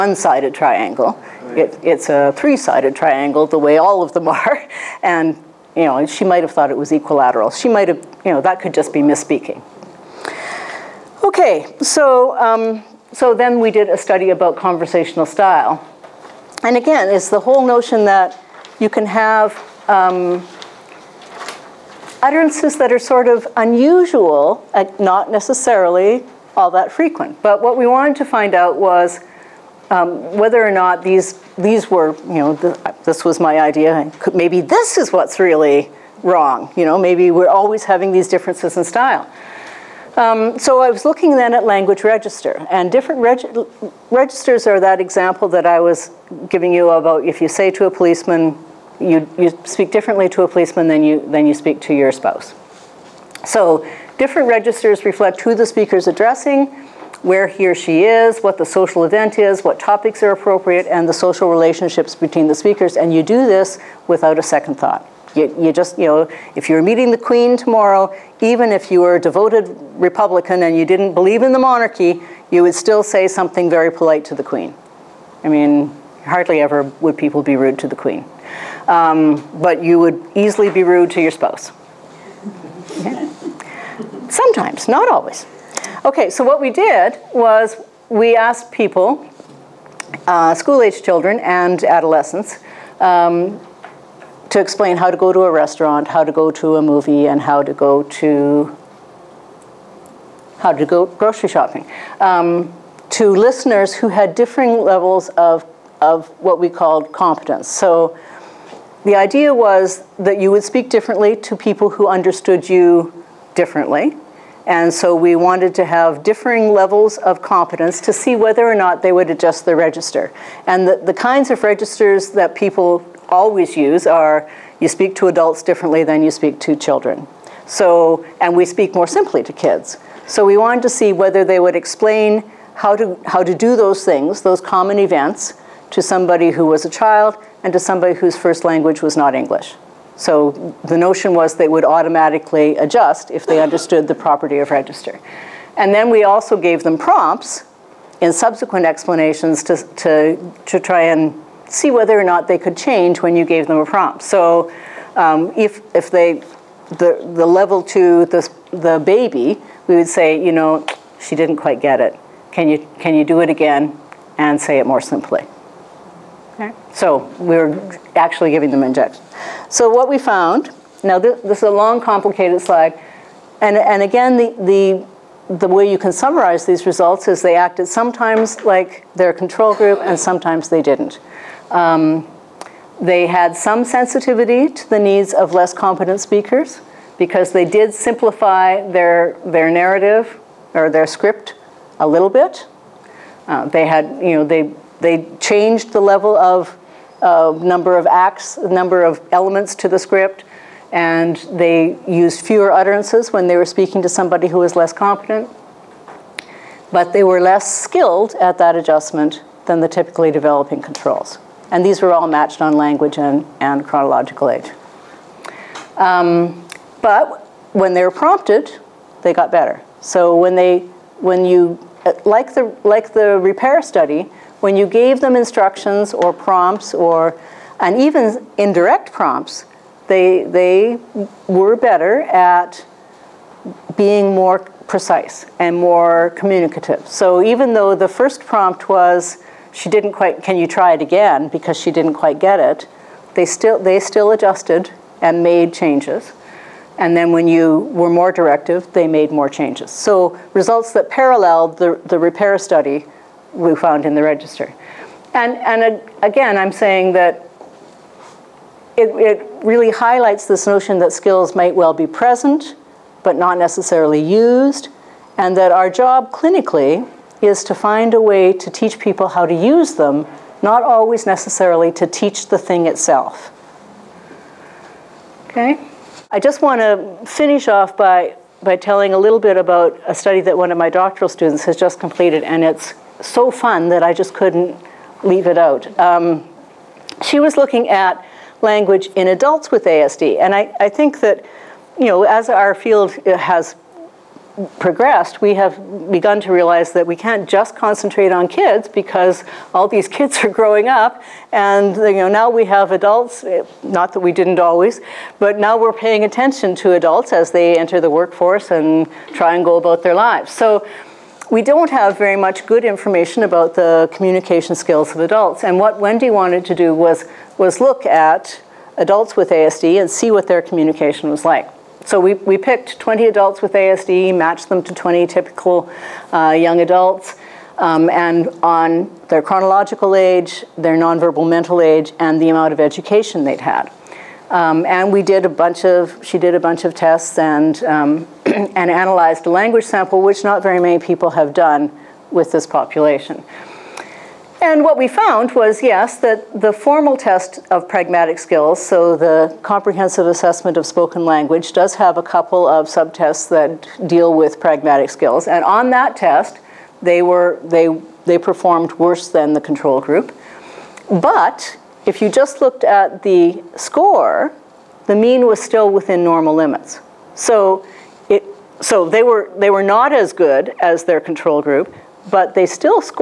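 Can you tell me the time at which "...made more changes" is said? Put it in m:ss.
4:09.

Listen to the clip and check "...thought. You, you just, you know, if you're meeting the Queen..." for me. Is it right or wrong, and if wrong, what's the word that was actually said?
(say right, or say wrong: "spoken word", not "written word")
right.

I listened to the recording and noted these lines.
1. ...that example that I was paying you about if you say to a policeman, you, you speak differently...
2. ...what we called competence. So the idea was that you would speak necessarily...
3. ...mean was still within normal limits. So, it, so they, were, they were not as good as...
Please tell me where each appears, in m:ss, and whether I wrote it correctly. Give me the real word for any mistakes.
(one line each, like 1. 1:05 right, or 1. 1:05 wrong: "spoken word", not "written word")
1. 0:44 wrong: "giving", not "paying"
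2. 1:46 wrong: "differently", not "necessarily"
3. 6:05 right.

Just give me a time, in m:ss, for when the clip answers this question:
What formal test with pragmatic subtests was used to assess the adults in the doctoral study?
5:49.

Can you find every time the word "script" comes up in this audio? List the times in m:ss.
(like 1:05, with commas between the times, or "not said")
3:11, 3:19.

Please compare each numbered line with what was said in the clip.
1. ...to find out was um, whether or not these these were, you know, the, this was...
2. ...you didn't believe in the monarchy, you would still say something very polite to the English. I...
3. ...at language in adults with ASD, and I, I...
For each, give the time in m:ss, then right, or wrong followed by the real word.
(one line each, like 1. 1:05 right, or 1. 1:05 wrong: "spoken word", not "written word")
1. 0:28 right
2. 1:10 wrong: "Queen", not "English"
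3. 4:47 right.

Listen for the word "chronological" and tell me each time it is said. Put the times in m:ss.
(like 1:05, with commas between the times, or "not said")
3:33, 5:29.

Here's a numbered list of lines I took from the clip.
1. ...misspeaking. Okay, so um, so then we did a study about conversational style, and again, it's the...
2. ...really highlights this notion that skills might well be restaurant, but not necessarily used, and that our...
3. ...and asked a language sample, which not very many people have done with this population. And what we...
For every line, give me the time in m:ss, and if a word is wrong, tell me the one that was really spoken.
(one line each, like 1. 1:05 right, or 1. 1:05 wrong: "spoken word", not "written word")
1. 0:08 right
2. 4:19 wrong: "present", not "restaurant"
3. 5:38 wrong: "analyzed", not "asked".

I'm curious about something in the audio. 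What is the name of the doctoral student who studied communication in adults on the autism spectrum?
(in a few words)
Wendy.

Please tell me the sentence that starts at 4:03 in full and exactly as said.
They still, they still adjusted and made changes.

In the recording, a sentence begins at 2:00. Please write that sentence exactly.
And the, the kinds of registers that people always use are you speak to adults differently than you speak to children.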